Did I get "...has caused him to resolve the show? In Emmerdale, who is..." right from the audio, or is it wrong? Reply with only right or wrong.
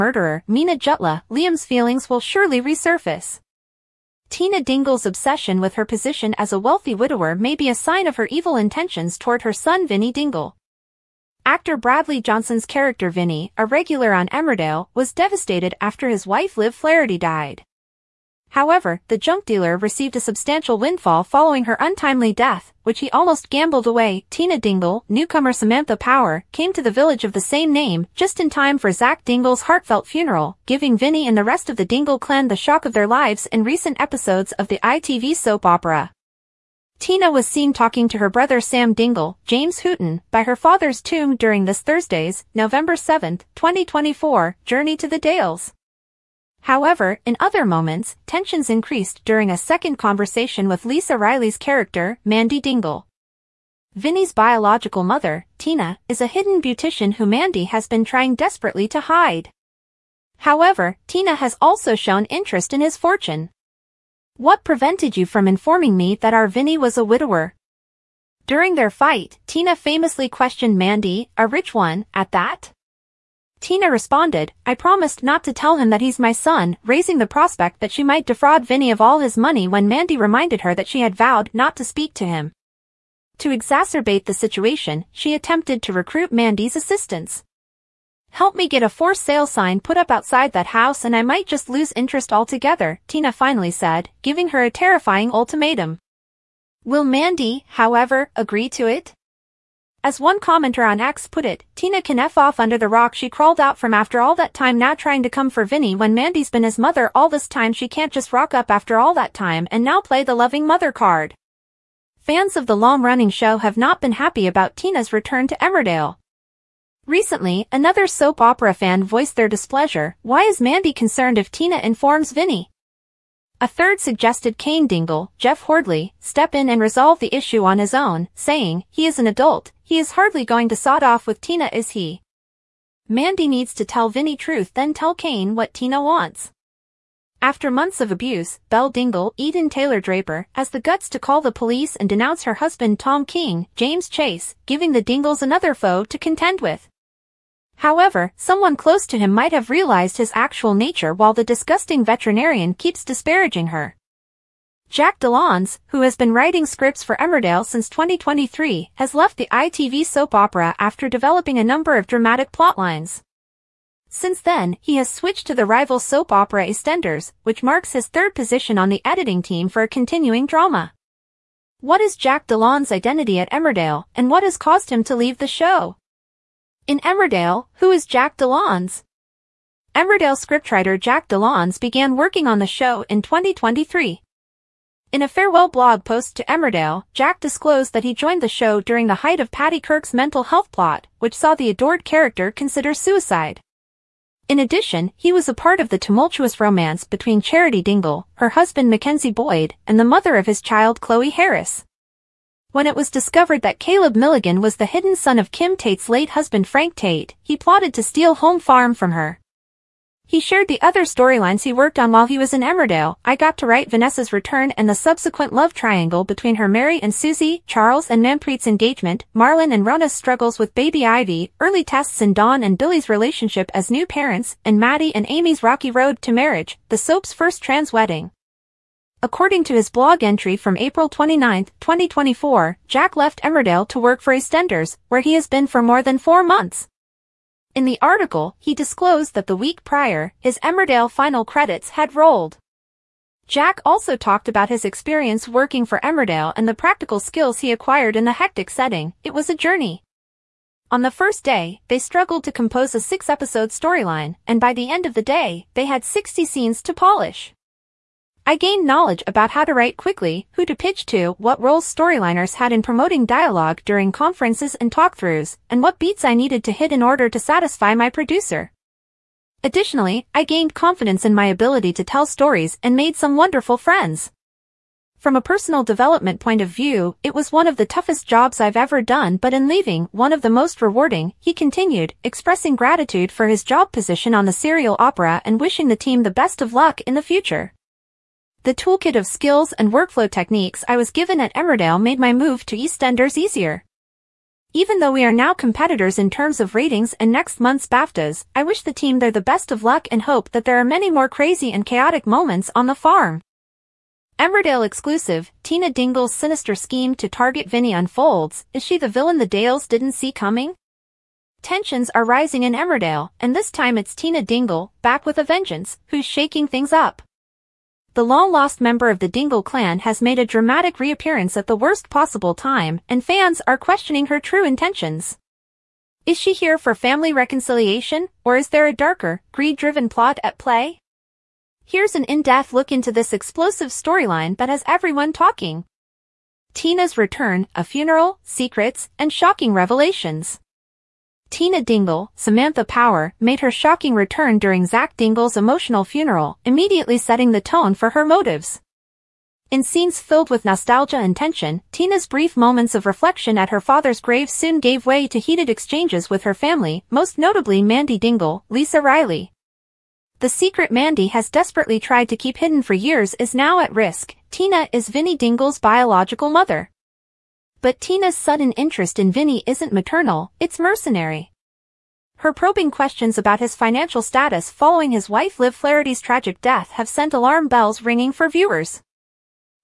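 wrong.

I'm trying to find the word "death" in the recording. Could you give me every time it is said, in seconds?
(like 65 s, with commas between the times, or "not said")
22 s, 376 s.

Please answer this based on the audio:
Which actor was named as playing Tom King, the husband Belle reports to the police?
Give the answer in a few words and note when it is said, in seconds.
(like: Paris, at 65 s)
James Chase, at 143 s.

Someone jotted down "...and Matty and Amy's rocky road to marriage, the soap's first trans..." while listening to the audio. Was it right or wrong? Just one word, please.
right.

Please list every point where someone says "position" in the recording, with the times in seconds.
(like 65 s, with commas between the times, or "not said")
5 s, 168 s, 283 s.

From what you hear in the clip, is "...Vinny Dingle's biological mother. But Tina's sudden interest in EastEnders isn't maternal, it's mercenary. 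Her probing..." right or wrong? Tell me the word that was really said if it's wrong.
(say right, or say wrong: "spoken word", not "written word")
wrong: "Vinny", not "EastEnders".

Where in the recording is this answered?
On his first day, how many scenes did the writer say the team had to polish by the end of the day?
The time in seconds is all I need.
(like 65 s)
256 s.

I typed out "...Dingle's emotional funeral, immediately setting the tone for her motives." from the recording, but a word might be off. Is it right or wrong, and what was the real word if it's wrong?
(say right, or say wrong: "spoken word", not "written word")
right.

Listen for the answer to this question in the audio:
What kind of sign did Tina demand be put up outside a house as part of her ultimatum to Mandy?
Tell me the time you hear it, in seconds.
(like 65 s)
88 s.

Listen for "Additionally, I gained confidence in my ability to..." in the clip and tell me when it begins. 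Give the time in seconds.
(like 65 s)
269 s.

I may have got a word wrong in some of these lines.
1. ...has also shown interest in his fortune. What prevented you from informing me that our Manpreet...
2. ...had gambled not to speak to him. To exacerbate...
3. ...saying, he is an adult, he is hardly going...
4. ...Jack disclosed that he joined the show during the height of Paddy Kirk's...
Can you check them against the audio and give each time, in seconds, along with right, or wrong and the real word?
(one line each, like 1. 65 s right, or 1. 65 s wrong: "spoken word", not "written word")
1. 61 s wrong: "Vinny", not "Manpreet"
2. 81 s wrong: "vowed", not "gambled"
3. 128 s right
4. 187 s right.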